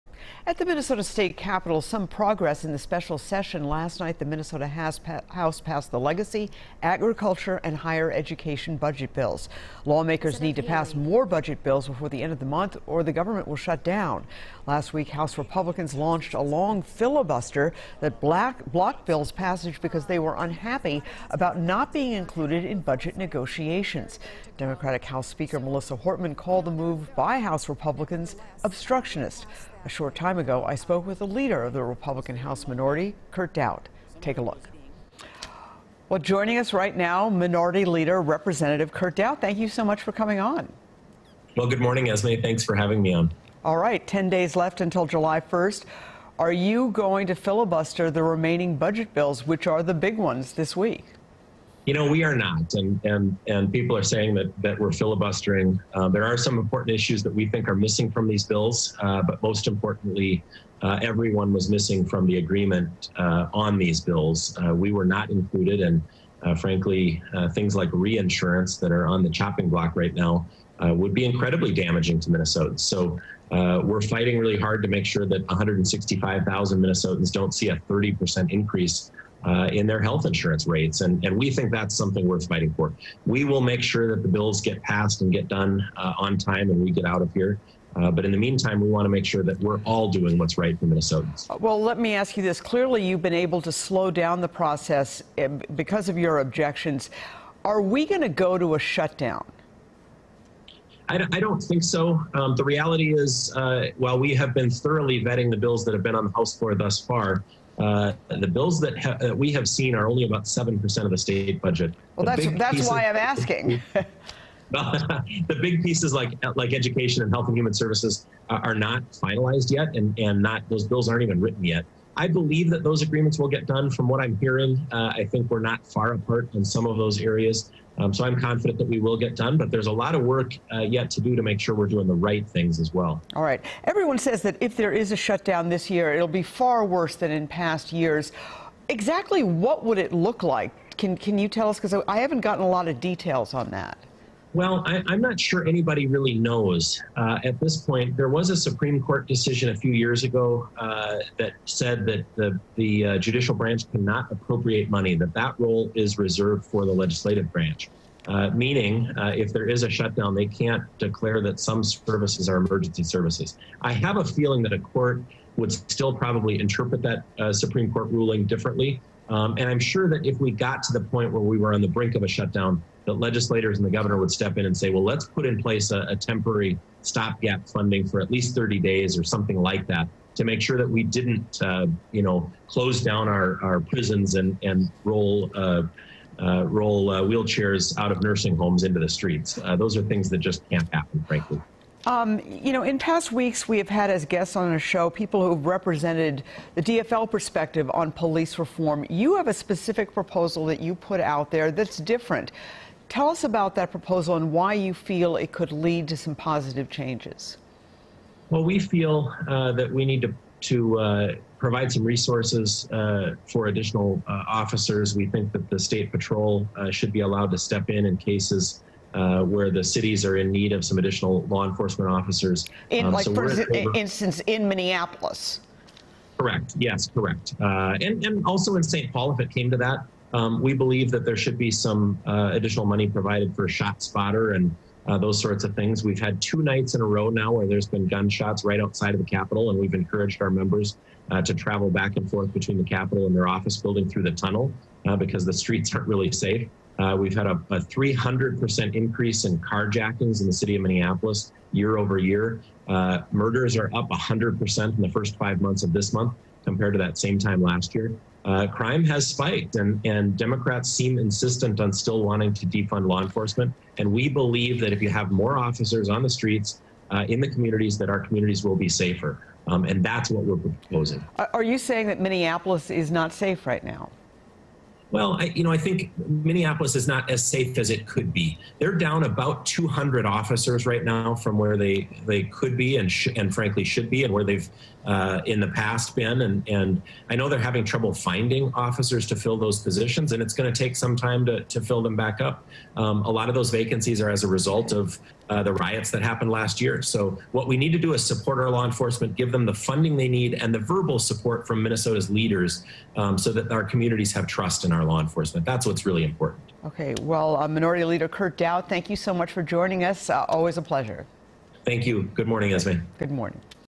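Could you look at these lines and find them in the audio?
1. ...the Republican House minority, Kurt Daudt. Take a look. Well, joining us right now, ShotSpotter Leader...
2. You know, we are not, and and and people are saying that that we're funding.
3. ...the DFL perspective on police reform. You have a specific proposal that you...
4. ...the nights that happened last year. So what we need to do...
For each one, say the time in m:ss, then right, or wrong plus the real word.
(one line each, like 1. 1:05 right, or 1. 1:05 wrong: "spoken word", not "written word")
1. 0:31 wrong: "Minority", not "ShotSpotter"
2. 0:51 wrong: "filibustering", not "funding"
3. 3:16 right
4. 4:55 wrong: "riots", not "nights".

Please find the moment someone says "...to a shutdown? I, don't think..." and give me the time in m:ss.
1:38.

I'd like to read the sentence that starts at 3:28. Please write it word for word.
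Well, we feel uh, that we need to, to uh, provide some resources uh, for additional uh, officers.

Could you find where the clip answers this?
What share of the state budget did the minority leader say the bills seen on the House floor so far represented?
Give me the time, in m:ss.
1:50.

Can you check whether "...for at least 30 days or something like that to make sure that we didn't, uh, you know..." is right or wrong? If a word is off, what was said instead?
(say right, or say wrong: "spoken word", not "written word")
right.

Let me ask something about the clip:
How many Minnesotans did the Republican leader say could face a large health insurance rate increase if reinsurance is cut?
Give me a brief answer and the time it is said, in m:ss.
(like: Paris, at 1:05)
165,000, at 1:15.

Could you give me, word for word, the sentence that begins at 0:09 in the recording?
Lawmakers need to pass more budget bills before the end of the month, or the government will shut down.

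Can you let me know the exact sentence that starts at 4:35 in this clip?
Well, I, you know, I think Minneapolis is not as safe as it could be.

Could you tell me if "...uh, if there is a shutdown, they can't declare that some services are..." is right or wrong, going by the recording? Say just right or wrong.
right.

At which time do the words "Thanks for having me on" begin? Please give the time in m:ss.
0:42.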